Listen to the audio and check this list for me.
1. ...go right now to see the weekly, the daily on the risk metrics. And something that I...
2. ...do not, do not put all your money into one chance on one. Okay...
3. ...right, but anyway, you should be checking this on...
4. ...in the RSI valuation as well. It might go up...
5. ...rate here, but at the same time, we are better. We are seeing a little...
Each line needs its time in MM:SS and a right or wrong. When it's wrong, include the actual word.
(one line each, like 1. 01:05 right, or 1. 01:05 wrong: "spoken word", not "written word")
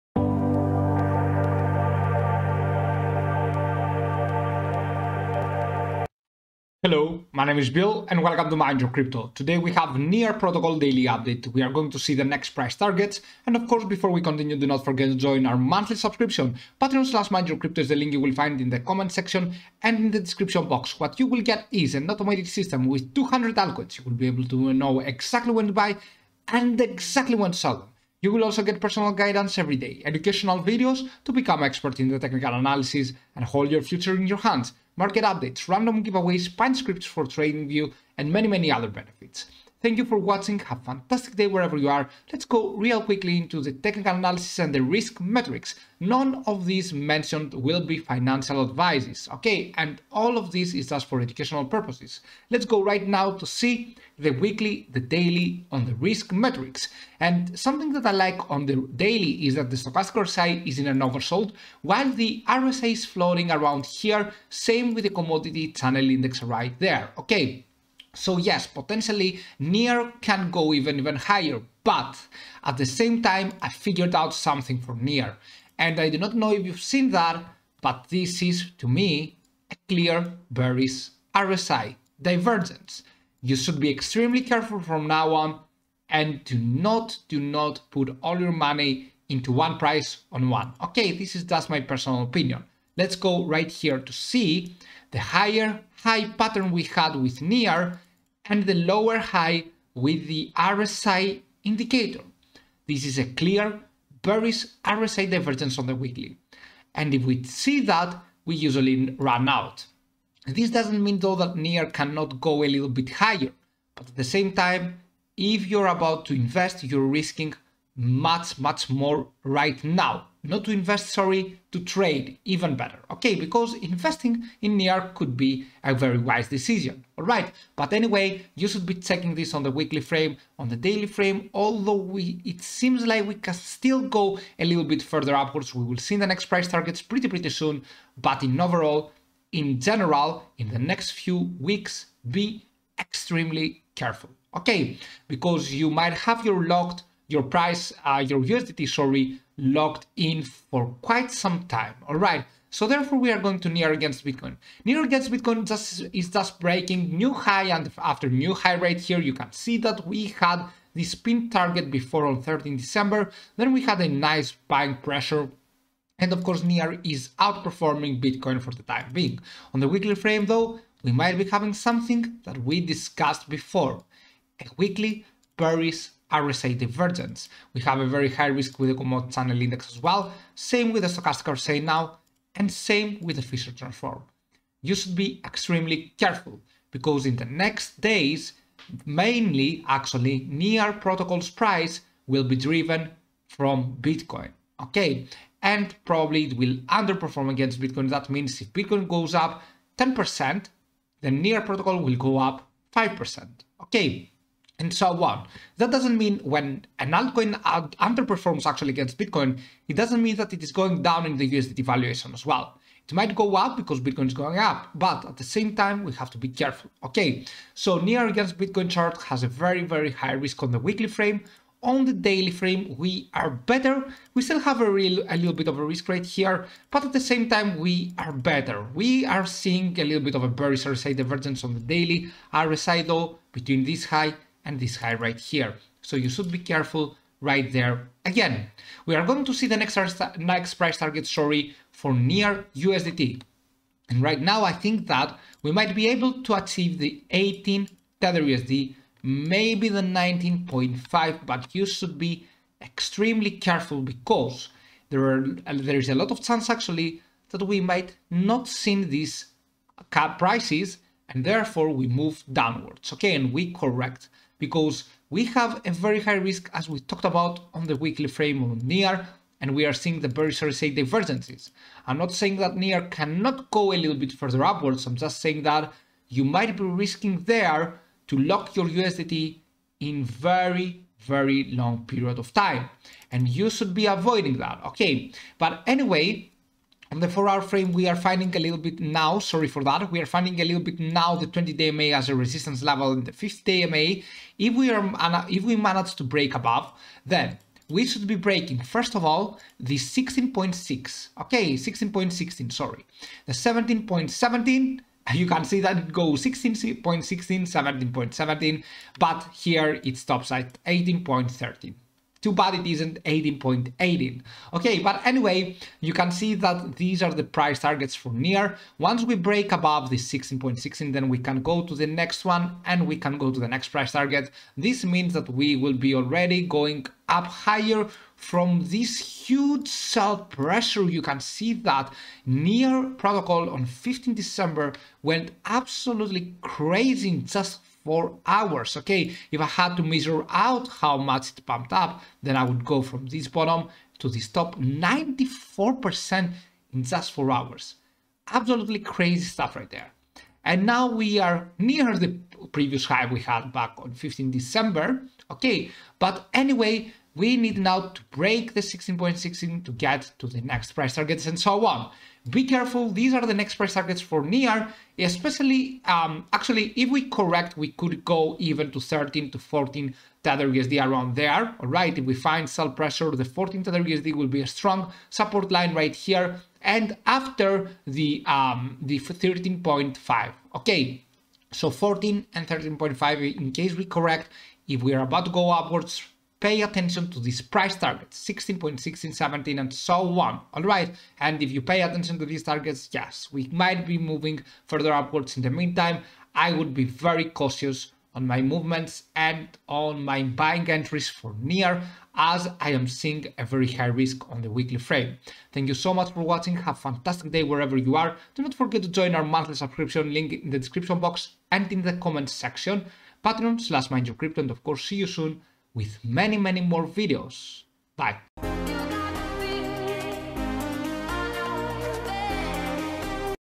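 1. 00:52 right
2. 01:26 wrong: "price", not "chance"
3. 02:07 right
4. 03:31 wrong: "USDT", not "RSI"
5. 03:46 right.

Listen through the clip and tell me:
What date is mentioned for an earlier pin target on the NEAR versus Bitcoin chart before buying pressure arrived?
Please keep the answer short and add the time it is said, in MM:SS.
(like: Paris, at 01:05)
13 December, at 02:42.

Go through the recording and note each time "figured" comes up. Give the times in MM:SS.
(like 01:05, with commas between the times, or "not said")
01:13.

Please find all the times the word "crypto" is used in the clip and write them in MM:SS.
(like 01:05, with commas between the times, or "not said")
00:08, 00:17, 06:54.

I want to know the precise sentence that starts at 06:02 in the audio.
Be careful, these are the next price targets for NEAR.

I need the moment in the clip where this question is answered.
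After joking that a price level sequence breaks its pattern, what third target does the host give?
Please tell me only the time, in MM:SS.
05:10.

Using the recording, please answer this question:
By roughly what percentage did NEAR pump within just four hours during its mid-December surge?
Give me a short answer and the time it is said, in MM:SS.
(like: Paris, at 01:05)
94%, at 05:44.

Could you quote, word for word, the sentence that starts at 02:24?
Okay, because you might have your locked your price, uh, your USDT, sorry, locked in for quite some time.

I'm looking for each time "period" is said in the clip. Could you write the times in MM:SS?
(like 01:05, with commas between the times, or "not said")
04:42.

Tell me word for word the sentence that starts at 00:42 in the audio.
Let's go real quickly into the technical analysis and the risk metrics.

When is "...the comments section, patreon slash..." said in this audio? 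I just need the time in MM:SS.
06:52.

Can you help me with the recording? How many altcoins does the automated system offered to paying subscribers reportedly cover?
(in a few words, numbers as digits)
200.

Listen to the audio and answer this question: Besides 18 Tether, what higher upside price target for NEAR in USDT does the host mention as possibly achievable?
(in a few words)
19.5.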